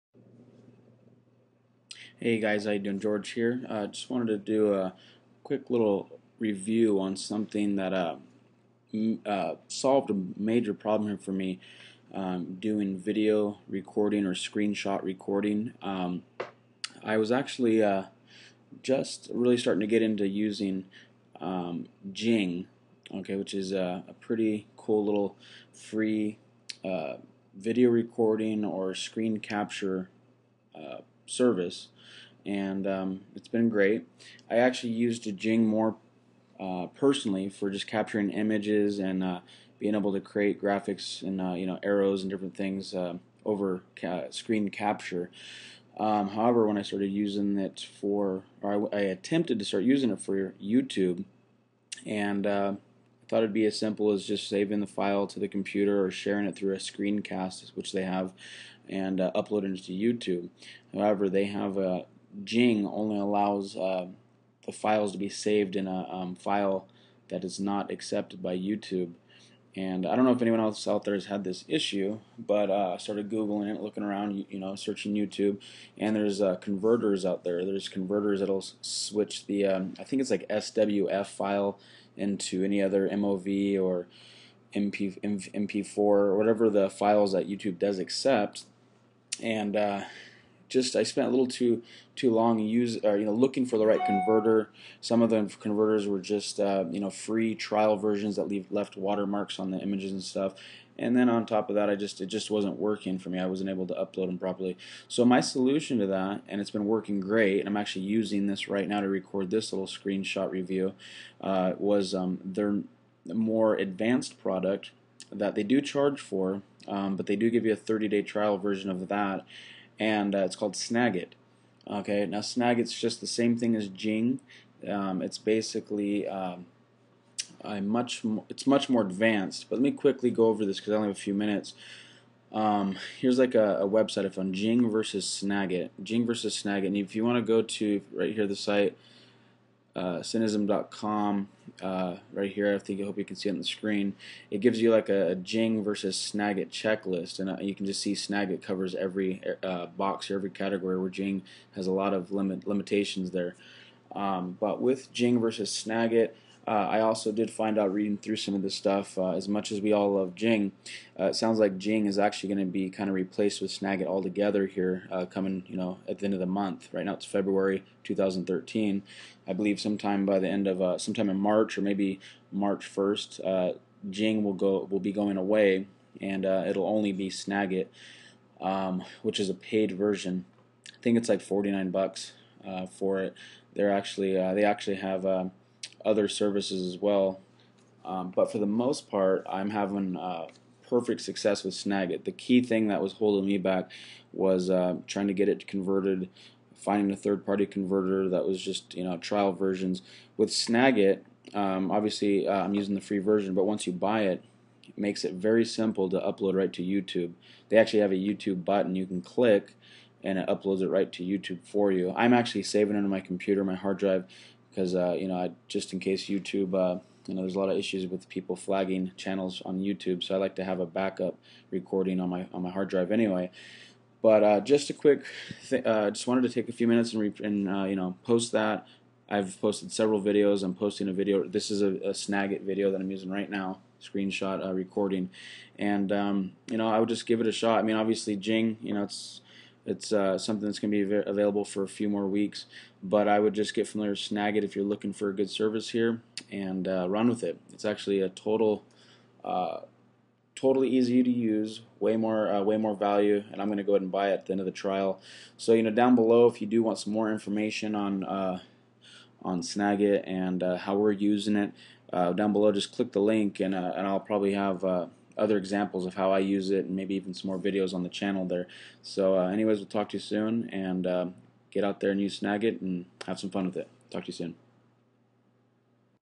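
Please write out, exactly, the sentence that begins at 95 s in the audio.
Some of the converters were just uh, you know free trial versions that leave left watermarks on the images and stuff.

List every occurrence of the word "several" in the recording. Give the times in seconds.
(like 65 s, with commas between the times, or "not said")
229 s.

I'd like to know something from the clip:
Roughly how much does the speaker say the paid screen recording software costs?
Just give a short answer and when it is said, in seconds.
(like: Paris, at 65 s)
$49, at 181 s.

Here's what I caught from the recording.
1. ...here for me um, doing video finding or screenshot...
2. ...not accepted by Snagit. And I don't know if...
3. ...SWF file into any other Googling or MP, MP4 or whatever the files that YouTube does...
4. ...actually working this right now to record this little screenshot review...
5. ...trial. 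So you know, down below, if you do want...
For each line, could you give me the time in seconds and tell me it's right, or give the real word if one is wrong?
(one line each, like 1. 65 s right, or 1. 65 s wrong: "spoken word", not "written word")
1. 11 s wrong: "recording", not "finding"
2. 67 s wrong: "YouTube", not "Snagit"
3. 80 s wrong: "MOV", not "Googling"
4. 107 s wrong: "using", not "working"
5. 254 s right.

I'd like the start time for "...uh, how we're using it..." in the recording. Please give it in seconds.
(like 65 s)
260 s.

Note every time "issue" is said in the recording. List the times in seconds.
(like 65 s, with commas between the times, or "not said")
71 s, 217 s.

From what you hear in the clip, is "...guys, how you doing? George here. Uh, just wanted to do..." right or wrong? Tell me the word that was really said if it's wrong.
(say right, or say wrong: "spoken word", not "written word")
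right.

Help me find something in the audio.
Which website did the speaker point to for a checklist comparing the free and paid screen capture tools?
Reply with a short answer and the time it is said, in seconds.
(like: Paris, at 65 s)
cynism.com, at 140 s.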